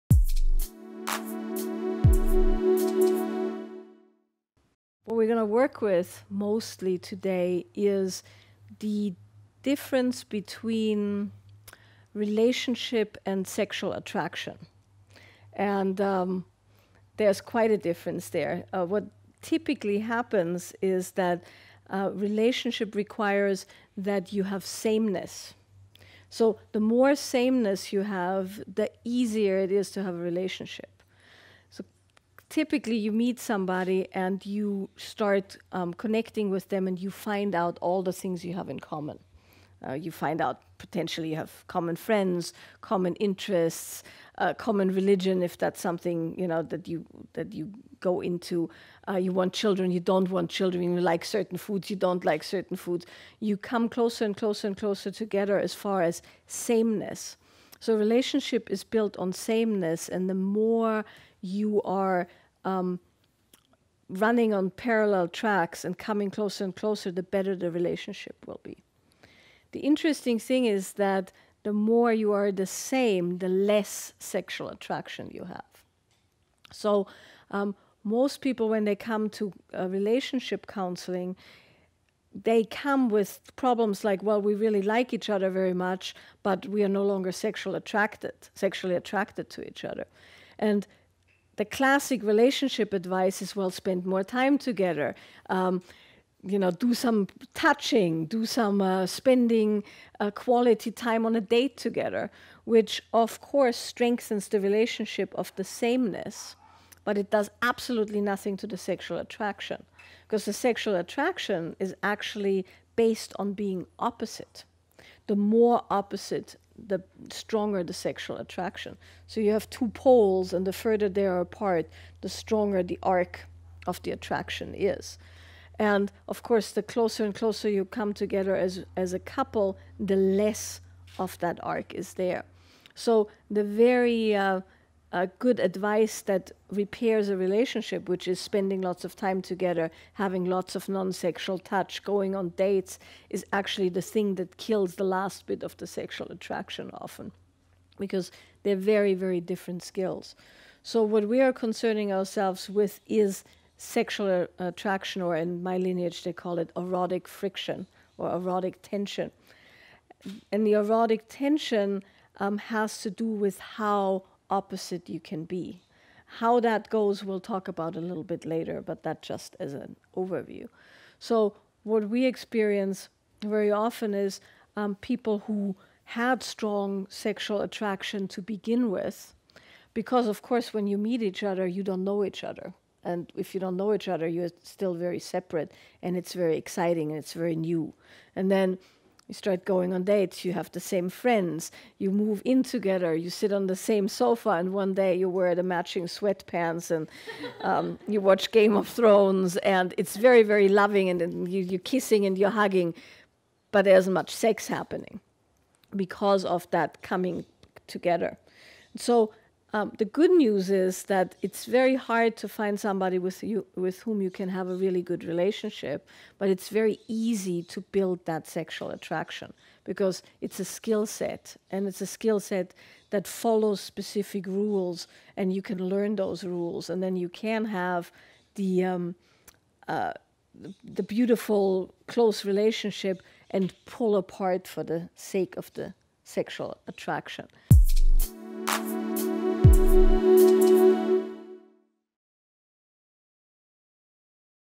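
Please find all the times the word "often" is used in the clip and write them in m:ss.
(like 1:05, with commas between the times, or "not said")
2:26, 2:53.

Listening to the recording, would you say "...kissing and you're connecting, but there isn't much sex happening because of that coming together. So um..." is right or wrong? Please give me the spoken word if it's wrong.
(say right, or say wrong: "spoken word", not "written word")
wrong: "hugging", not "connecting".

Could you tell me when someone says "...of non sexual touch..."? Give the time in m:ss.
2:20.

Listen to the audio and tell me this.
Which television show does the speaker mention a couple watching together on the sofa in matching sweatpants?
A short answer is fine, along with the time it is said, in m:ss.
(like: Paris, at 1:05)
Game of Thrones, at 3:18.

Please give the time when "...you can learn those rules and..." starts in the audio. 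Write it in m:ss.
3:45.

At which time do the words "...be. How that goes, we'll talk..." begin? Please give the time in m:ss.
2:45.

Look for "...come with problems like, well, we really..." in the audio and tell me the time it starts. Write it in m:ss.
1:22.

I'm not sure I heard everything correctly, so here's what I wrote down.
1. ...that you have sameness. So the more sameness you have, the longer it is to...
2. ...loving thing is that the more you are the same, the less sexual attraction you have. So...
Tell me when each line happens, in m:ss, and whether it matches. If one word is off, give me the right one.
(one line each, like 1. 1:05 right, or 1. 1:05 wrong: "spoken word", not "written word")
1. 0:23 wrong: "easier", not "longer"
2. 1:09 wrong: "interesting", not "loving".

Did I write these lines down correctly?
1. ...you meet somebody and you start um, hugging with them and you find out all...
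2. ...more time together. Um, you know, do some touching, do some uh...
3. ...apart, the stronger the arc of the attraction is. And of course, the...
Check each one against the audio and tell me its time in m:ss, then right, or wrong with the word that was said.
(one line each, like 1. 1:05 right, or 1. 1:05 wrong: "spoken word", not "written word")
1. 0:32 wrong: "connecting", not "hugging"
2. 1:34 right
3. 2:01 right.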